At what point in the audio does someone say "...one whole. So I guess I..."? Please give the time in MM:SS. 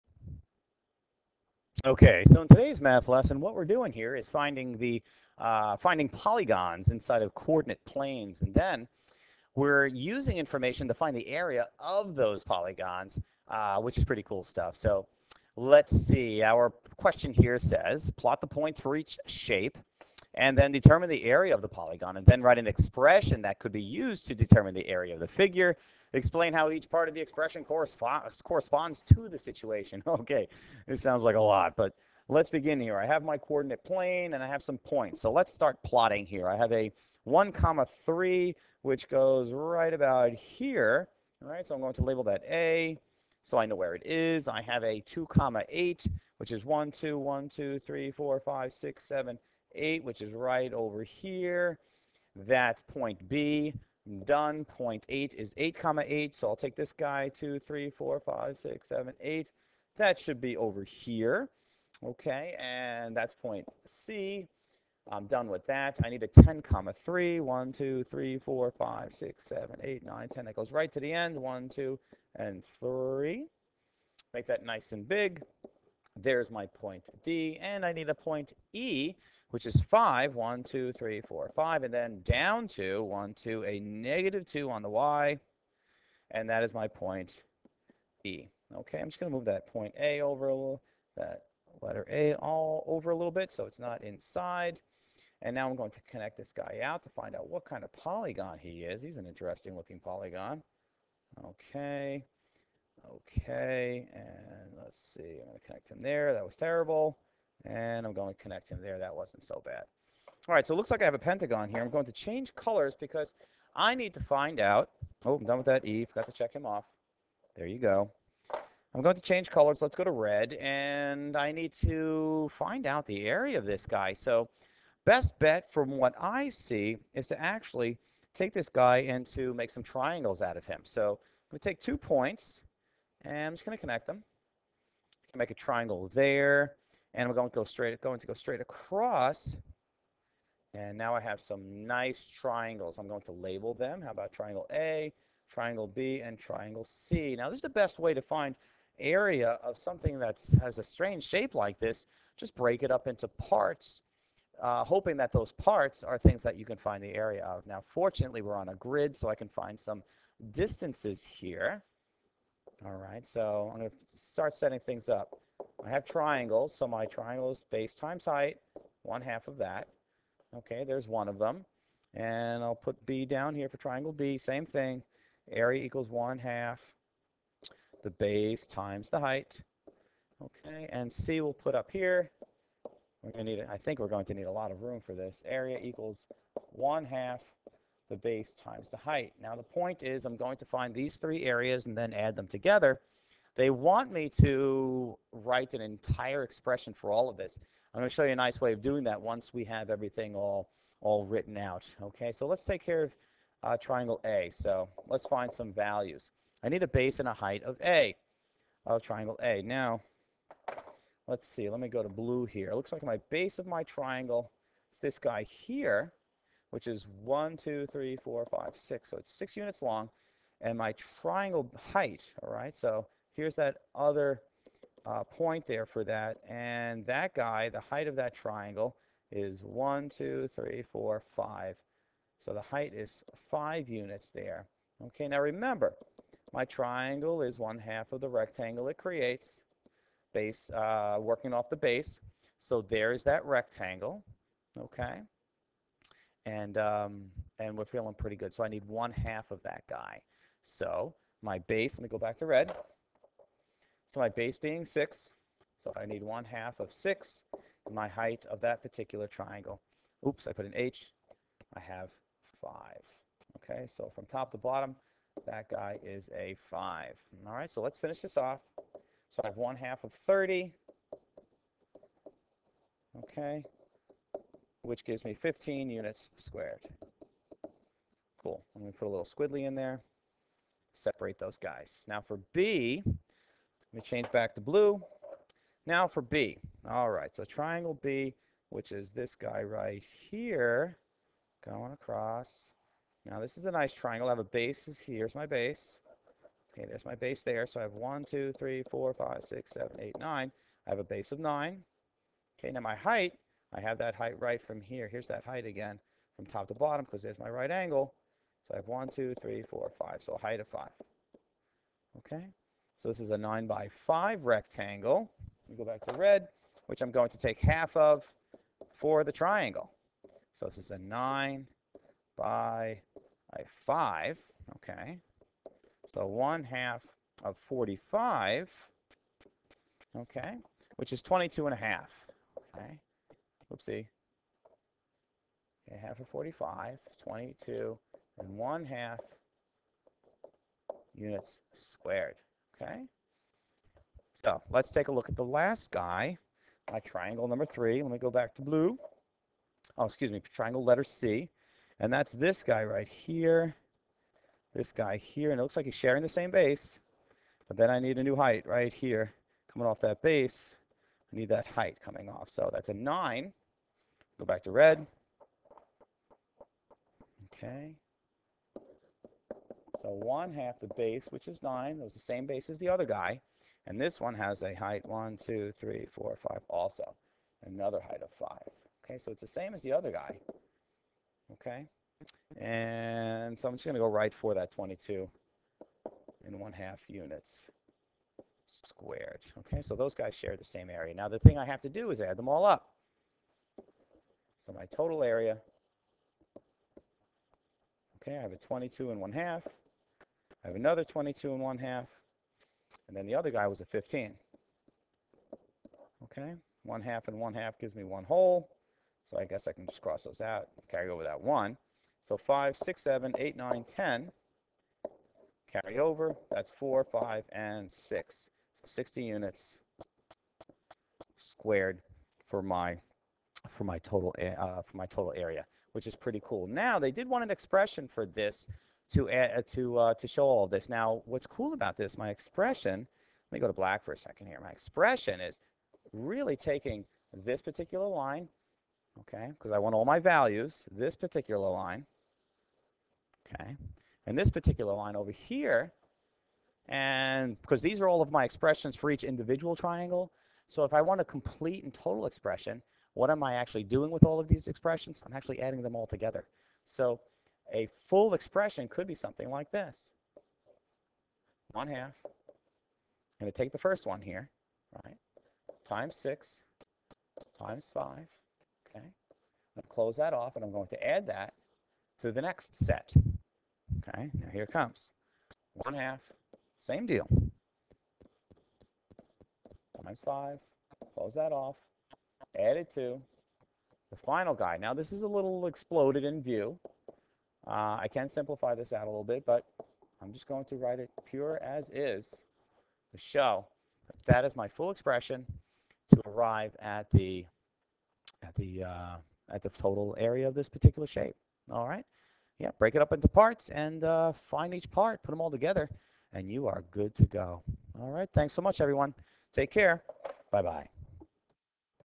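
06:48.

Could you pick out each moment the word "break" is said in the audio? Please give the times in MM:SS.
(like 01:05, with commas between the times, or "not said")
02:32, 08:22.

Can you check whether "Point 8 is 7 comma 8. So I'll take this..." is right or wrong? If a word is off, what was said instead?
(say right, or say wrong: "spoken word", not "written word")
wrong: "8", not "7".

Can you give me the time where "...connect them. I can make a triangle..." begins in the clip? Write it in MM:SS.
02:13.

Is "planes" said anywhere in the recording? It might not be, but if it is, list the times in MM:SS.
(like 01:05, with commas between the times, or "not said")
00:07, 00:33.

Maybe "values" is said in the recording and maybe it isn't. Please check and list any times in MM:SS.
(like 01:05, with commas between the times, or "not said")
03:25, 07:20.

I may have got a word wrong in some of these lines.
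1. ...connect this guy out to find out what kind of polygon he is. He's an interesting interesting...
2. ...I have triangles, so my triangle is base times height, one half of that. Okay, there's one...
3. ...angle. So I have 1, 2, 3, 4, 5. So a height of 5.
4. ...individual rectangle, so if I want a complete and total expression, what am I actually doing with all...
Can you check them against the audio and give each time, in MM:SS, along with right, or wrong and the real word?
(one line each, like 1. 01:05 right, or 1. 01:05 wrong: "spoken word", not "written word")
1. 01:36 wrong: "looking", not "interesting"
2. 02:45 right
3. 05:07 right
4. 07:29 wrong: "triangle", not "rectangle".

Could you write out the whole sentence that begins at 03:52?
So the height is 5 units there.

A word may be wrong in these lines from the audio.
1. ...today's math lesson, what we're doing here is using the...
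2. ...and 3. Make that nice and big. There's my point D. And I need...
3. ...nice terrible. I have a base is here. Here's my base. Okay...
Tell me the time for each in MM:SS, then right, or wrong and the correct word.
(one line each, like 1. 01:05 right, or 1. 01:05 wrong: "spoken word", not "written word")
1. 00:02 wrong: "finding", not "using"
2. 01:12 right
3. 04:53 wrong: "triangle", not "terrible".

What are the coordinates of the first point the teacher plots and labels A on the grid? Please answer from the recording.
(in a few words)
1, 3.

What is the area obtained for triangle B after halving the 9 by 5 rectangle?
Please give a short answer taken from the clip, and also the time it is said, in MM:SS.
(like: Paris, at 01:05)
22 1/2, at 05:31.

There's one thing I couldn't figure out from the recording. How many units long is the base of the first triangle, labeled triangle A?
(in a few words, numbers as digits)
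6.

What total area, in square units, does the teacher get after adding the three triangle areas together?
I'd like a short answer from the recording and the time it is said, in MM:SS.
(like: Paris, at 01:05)
60, at 06:58.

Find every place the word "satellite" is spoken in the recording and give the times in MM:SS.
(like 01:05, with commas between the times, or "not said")
not said.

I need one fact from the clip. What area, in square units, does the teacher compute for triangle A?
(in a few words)
15.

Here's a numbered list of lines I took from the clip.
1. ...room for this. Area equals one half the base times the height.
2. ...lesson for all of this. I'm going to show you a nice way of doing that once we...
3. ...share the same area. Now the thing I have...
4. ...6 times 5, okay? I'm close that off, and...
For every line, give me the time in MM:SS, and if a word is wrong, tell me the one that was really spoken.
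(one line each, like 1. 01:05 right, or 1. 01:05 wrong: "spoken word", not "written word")
1. 03:04 right
2. 03:16 wrong: "expression", not "lesson"
3. 06:30 right
4. 07:46 right.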